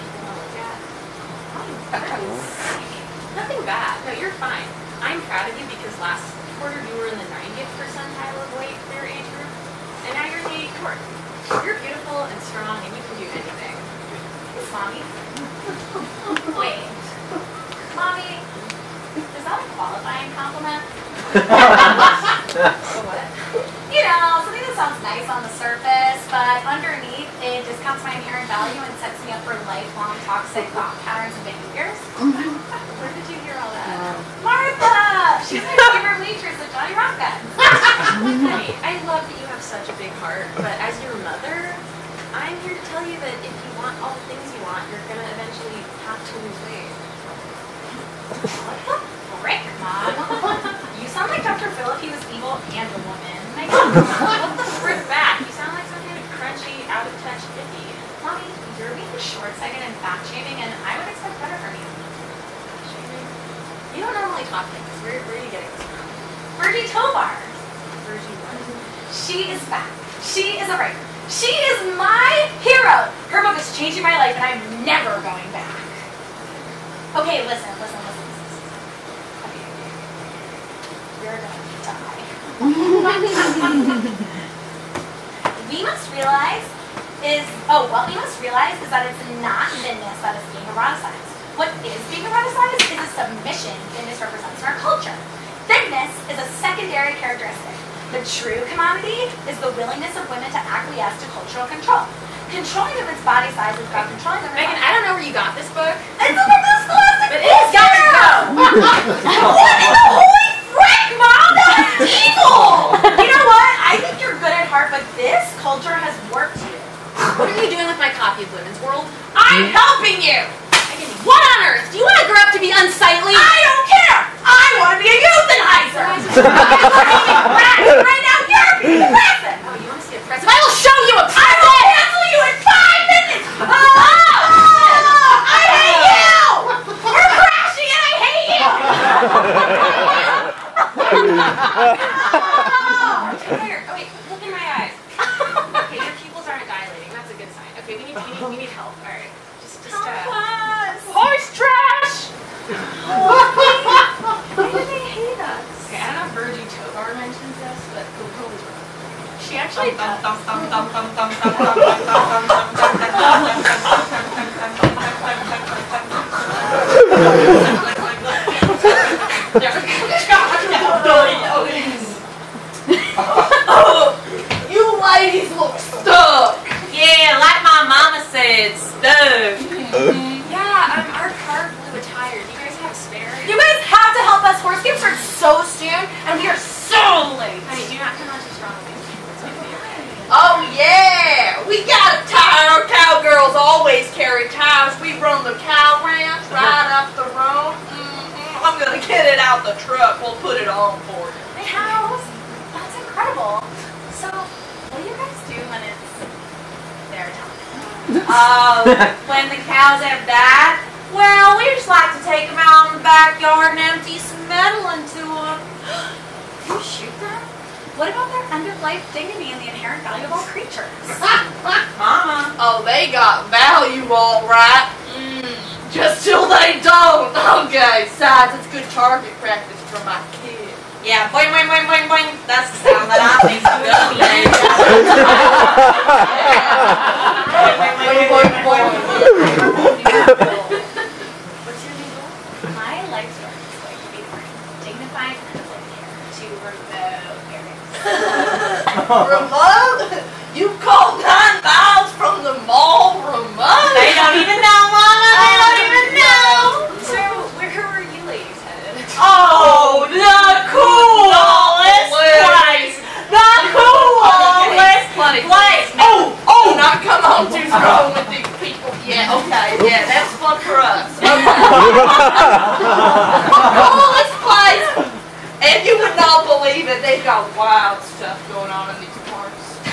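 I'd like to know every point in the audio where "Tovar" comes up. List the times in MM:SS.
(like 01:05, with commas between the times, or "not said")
01:06, 02:36.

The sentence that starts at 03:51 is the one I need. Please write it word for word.
Yeah, boing, boing, boing, boing, boing.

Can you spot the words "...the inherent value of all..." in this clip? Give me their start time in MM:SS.
03:39.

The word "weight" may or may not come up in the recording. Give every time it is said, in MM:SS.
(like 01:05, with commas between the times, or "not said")
00:08, 00:46.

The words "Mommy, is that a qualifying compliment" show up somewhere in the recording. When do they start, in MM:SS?
00:17.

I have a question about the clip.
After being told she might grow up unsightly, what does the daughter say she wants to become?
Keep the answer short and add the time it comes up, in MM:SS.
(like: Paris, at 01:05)
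YouTuber, at 02:05.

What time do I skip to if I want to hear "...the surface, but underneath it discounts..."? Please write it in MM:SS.
00:25.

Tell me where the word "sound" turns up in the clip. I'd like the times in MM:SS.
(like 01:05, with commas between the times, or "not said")
00:24, 00:51, 00:55, 03:52.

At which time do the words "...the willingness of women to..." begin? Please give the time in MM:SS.
01:39.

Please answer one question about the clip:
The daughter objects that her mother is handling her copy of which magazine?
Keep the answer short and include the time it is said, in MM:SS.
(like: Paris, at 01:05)
Women's World, at 01:58.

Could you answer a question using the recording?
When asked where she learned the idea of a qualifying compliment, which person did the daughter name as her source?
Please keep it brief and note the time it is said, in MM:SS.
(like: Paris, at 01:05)
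Martha, at 00:34.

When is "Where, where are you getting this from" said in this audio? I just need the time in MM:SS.
01:05.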